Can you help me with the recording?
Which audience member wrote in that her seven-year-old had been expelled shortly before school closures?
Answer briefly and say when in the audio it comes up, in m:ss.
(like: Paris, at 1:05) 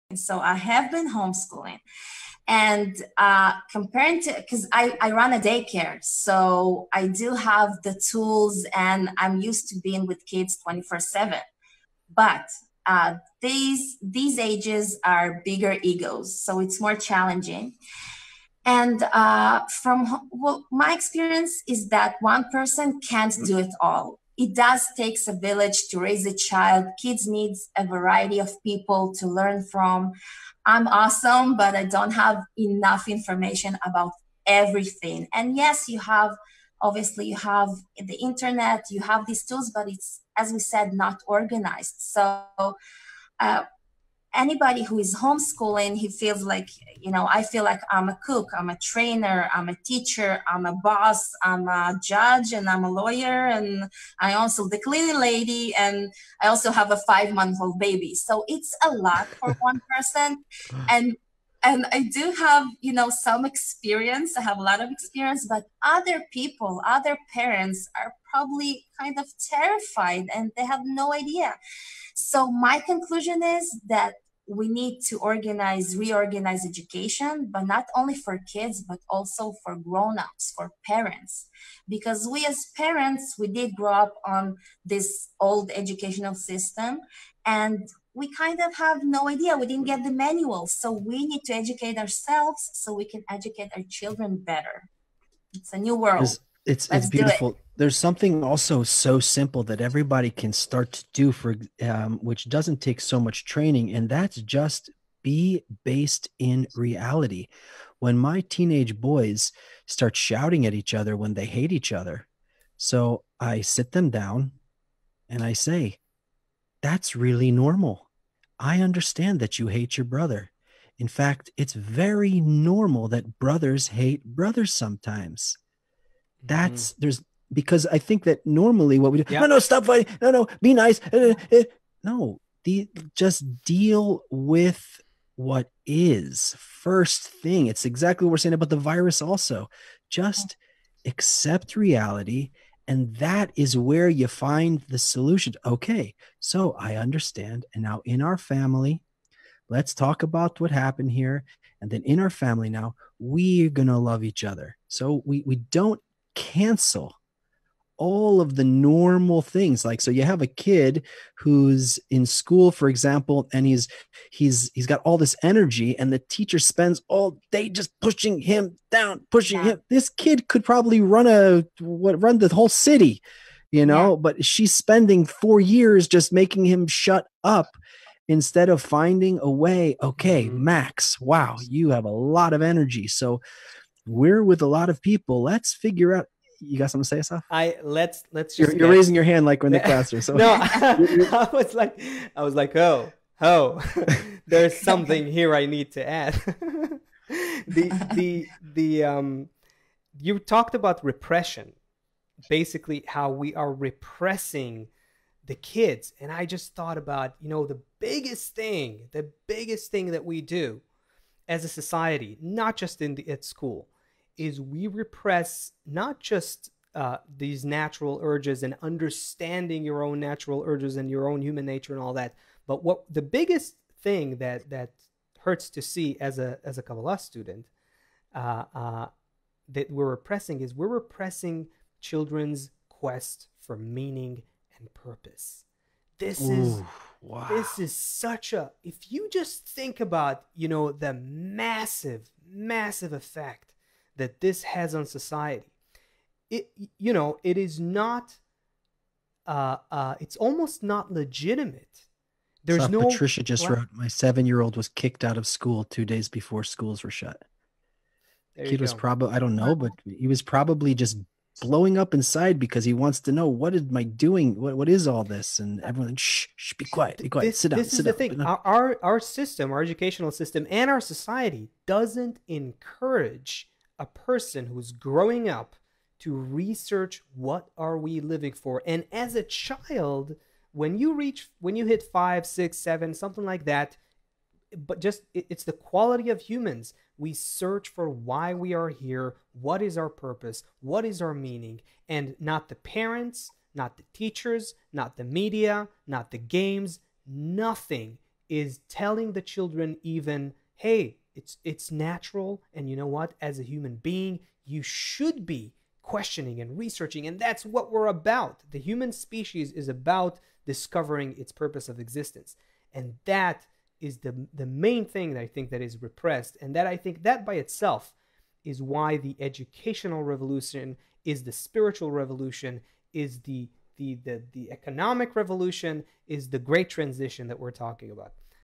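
Patricia, at 4:13.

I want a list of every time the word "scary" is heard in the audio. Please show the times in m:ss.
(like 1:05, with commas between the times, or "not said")
not said.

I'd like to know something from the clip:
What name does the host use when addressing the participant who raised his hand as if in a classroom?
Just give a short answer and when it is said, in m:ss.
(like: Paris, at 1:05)
Asaf, at 3:07.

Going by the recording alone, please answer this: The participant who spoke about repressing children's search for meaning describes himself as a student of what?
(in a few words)
Kabbalah.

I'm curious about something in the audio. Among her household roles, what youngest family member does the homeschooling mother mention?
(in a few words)
five month old baby.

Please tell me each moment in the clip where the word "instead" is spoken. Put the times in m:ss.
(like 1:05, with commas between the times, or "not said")
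2:58.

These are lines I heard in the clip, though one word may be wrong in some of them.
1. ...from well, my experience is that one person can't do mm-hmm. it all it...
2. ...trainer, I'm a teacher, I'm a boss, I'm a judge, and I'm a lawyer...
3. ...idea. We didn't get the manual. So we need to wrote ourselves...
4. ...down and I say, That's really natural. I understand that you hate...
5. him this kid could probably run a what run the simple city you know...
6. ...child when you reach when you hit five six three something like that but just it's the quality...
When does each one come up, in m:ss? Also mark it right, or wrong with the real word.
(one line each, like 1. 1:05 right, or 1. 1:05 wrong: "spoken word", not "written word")
1. 0:19 right
2. 0:48 right
3. 1:29 wrong: "educate", not "wrote"
4. 1:54 wrong: "normal", not "natural"
5. 2:49 wrong: "whole", not "simple"
6. 4:39 wrong: "seven", not "three".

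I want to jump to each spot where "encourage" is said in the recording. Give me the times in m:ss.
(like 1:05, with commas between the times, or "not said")
4:32.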